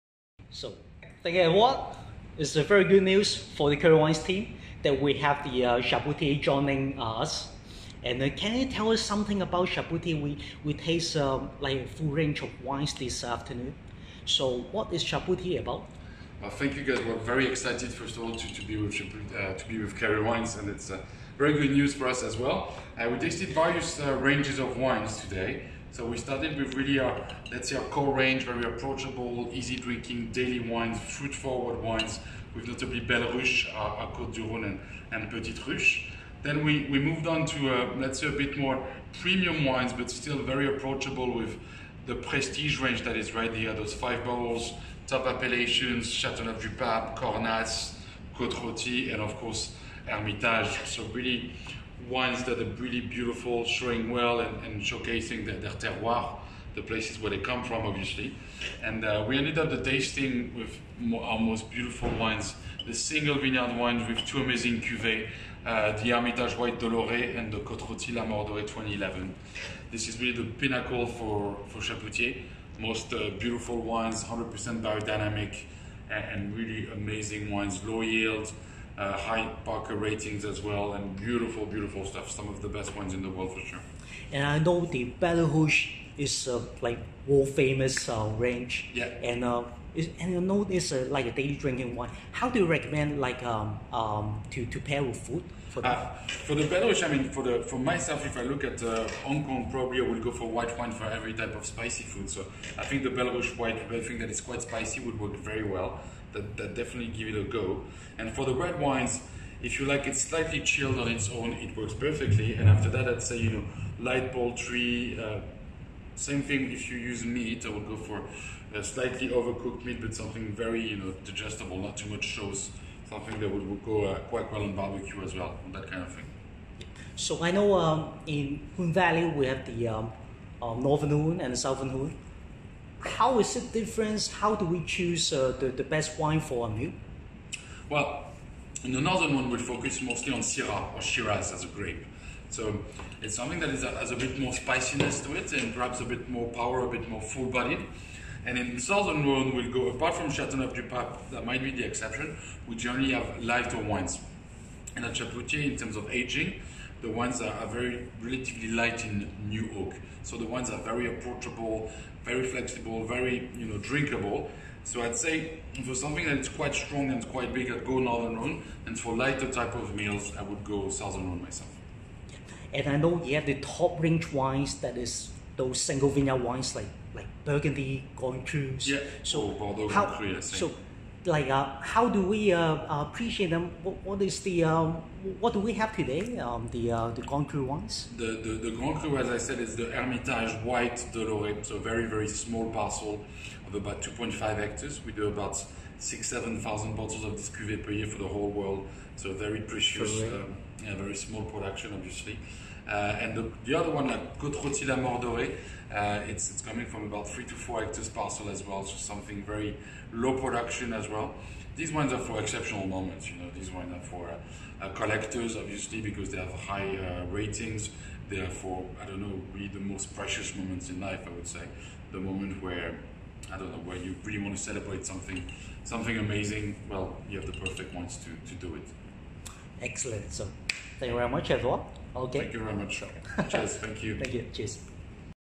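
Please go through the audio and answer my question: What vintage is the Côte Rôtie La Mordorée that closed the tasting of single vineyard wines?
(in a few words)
2011.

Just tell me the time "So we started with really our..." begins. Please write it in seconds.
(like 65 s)
25 s.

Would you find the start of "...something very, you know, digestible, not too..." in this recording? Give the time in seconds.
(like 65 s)
120 s.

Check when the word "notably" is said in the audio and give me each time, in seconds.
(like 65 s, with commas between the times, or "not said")
32 s.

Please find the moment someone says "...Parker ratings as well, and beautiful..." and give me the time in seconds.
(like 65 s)
79 s.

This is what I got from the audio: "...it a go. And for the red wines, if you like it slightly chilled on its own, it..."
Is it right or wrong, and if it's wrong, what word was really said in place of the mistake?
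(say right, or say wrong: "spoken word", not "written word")
right.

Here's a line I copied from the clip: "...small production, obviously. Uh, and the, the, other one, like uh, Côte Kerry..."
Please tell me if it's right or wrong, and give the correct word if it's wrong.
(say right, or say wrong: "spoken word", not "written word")
wrong: "Rôtie", not "Kerry".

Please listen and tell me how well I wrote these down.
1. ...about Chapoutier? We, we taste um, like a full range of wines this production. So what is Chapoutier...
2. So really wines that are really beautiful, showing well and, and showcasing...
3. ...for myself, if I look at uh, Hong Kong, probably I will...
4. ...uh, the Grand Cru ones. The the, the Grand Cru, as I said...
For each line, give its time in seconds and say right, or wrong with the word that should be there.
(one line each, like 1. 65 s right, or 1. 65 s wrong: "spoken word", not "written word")
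1. 9 s wrong: "afternoon", not "production"
2. 50 s right
3. 97 s right
4. 186 s right.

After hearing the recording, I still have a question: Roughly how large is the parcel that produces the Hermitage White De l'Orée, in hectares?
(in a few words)
2.5 hectares.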